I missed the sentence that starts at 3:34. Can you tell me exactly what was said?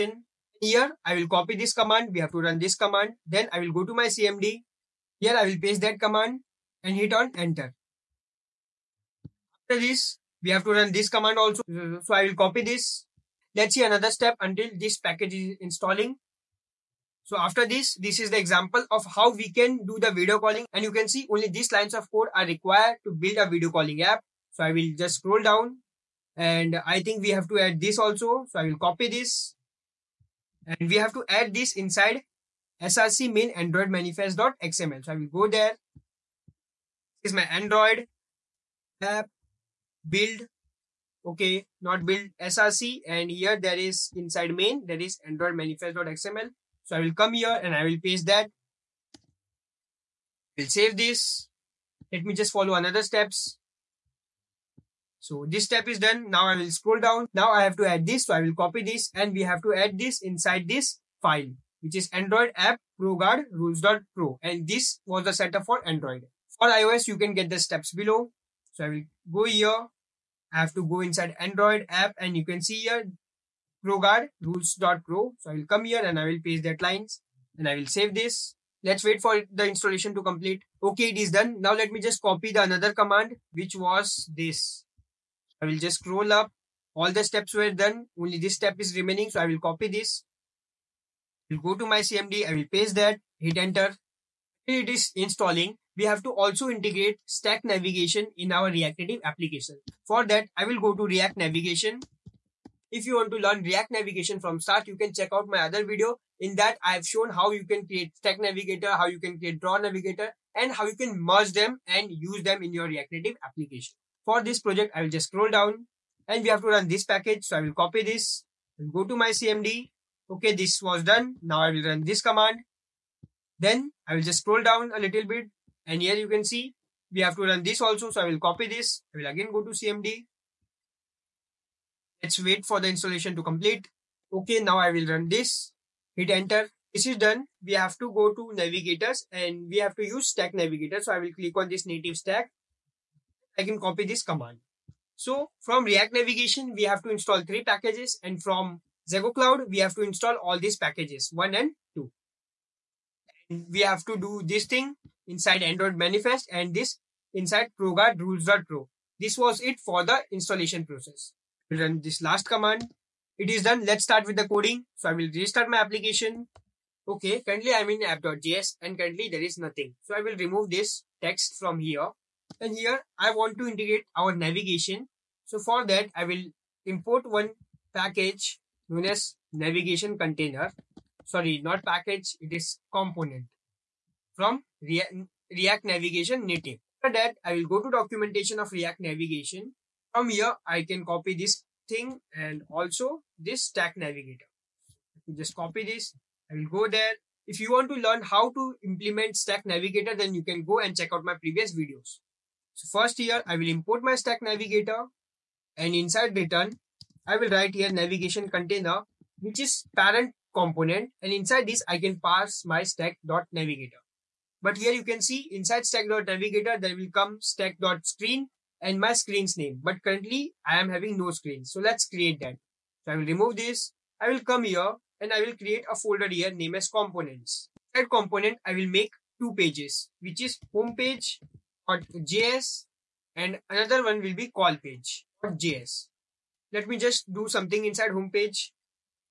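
But here you can see inside stack.navigator there will come stack.screen and my screen's name.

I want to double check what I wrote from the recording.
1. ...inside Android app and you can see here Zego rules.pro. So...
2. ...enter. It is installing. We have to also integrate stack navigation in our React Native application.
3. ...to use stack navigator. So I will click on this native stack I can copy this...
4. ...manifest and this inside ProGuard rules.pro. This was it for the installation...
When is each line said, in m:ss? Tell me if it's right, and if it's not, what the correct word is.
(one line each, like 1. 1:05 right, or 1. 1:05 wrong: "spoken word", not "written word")
1. 1:11 wrong: "ProGuard", not "Zego"
2. 1:33 right
3. 2:19 right
4. 2:35 right.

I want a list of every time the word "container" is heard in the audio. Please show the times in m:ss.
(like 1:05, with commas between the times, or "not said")
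3:00, 3:28.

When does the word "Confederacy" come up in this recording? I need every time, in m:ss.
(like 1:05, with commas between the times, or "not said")
not said.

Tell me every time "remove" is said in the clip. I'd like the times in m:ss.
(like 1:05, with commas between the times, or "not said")
2:50, 3:43.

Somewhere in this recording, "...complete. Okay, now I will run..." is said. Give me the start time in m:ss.
2:13.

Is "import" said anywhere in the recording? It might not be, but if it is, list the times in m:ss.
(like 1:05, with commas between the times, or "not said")
2:56, 3:23.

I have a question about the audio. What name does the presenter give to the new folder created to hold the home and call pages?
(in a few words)
components.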